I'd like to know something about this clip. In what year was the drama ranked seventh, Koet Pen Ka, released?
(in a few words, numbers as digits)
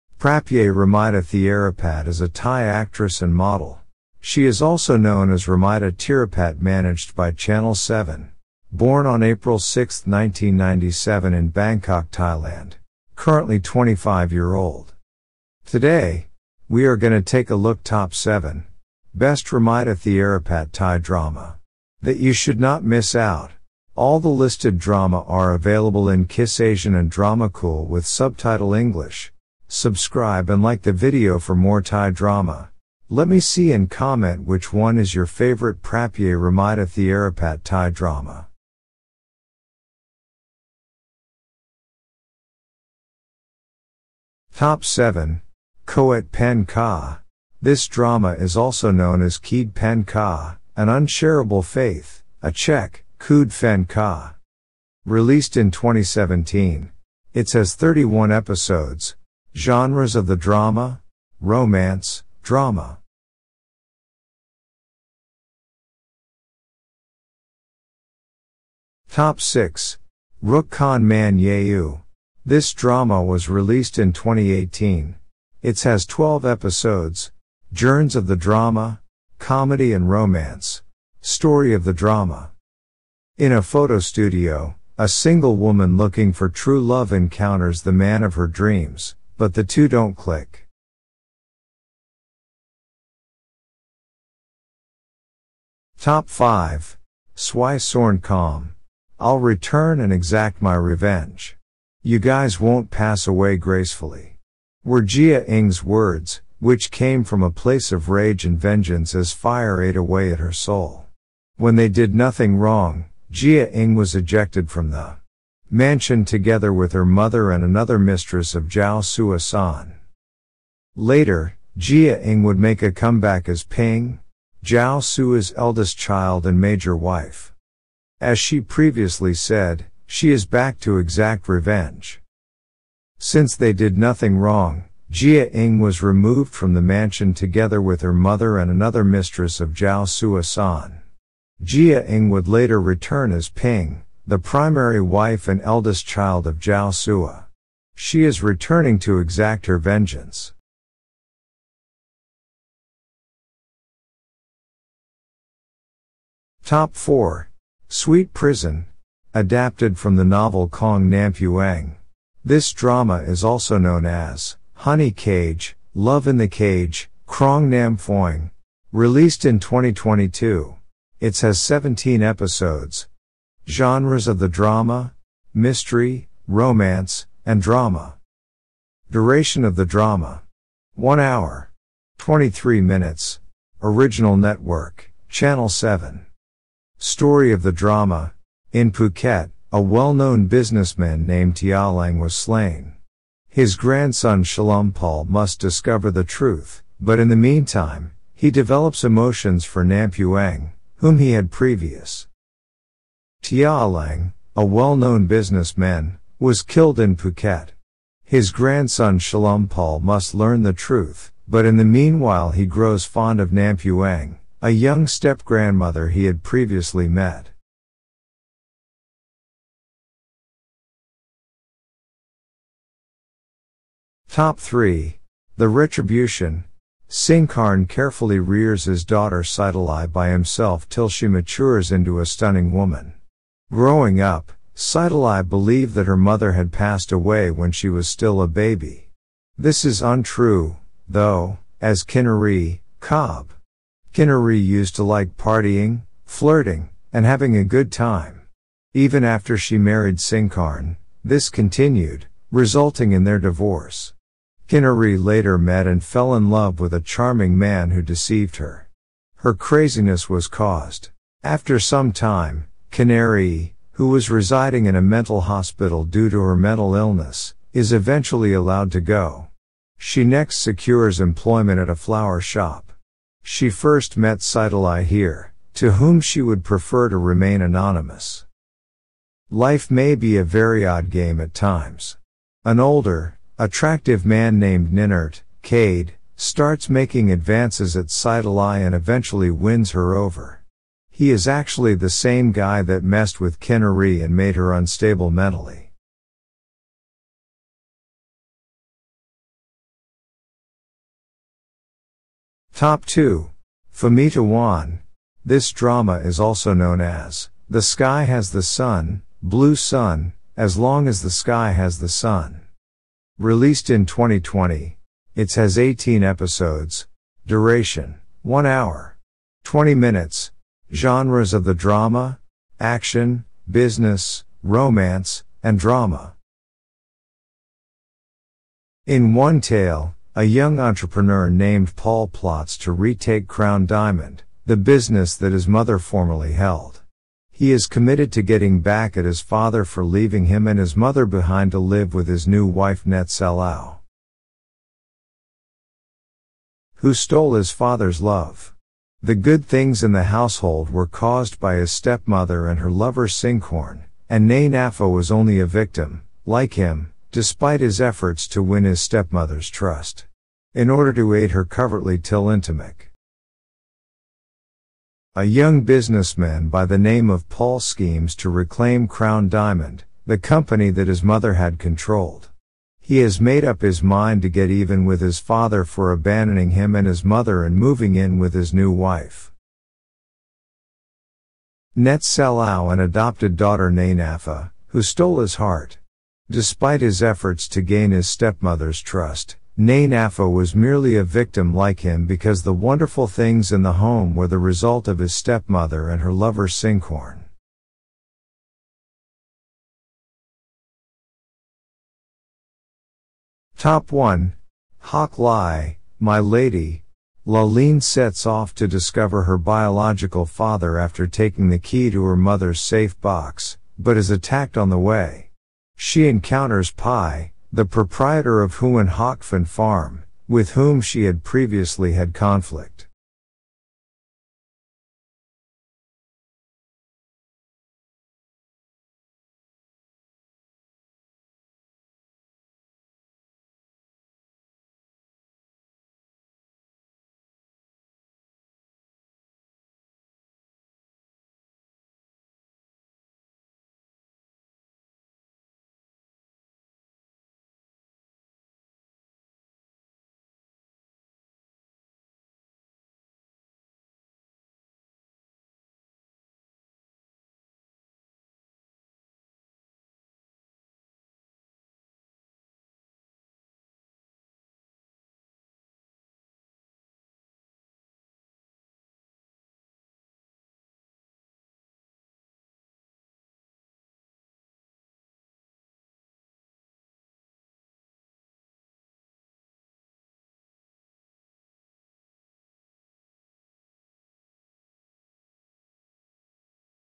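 2017.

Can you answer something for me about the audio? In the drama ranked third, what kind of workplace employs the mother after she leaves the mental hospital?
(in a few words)
a flower shop.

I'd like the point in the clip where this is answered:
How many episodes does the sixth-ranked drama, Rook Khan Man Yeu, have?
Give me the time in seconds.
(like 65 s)
76 s.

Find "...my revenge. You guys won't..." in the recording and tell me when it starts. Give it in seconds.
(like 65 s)
100 s.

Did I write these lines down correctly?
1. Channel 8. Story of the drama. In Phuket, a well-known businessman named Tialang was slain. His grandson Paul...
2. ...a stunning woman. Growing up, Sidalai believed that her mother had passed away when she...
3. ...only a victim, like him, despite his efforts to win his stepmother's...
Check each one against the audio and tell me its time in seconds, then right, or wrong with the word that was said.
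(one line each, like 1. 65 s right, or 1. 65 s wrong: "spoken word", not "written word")
1. 185 s wrong: "7", not "8"
2. 232 s right
3. 355 s right.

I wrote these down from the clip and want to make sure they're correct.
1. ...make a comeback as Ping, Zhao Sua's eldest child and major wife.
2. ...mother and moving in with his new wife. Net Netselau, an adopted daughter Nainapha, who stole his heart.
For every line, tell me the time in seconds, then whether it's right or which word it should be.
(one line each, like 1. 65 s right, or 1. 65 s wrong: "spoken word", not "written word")
1. 122 s right
2. 377 s right.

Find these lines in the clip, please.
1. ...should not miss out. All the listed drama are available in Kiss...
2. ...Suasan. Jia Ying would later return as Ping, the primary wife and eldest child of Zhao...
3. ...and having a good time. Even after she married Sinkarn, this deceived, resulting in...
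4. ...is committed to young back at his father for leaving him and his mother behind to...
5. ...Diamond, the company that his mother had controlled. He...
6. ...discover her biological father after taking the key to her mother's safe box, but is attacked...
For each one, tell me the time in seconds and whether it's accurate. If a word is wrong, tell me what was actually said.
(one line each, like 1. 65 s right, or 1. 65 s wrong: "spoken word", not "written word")
1. 22 s right
2. 140 s right
3. 247 s wrong: "continued", not "deceived"
4. 337 s wrong: "getting", not "young"
5. 369 s right
6. 408 s right.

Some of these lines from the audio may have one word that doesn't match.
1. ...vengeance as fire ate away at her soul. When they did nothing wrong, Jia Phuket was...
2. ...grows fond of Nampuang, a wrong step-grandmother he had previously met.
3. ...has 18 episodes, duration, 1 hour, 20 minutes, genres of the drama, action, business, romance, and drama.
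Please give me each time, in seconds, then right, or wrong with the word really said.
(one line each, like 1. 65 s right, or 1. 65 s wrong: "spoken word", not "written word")
1. 108 s wrong: "Ing", not "Phuket"
2. 212 s wrong: "young", not "wrong"
3. 315 s right.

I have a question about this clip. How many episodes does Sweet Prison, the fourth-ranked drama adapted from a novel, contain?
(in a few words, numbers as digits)
17.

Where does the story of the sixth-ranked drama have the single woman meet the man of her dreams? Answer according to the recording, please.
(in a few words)
a photo studio.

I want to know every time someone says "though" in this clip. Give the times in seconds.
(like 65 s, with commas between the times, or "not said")
241 s.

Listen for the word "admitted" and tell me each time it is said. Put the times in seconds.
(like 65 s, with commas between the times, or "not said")
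not said.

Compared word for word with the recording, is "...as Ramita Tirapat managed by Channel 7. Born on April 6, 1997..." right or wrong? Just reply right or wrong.
right.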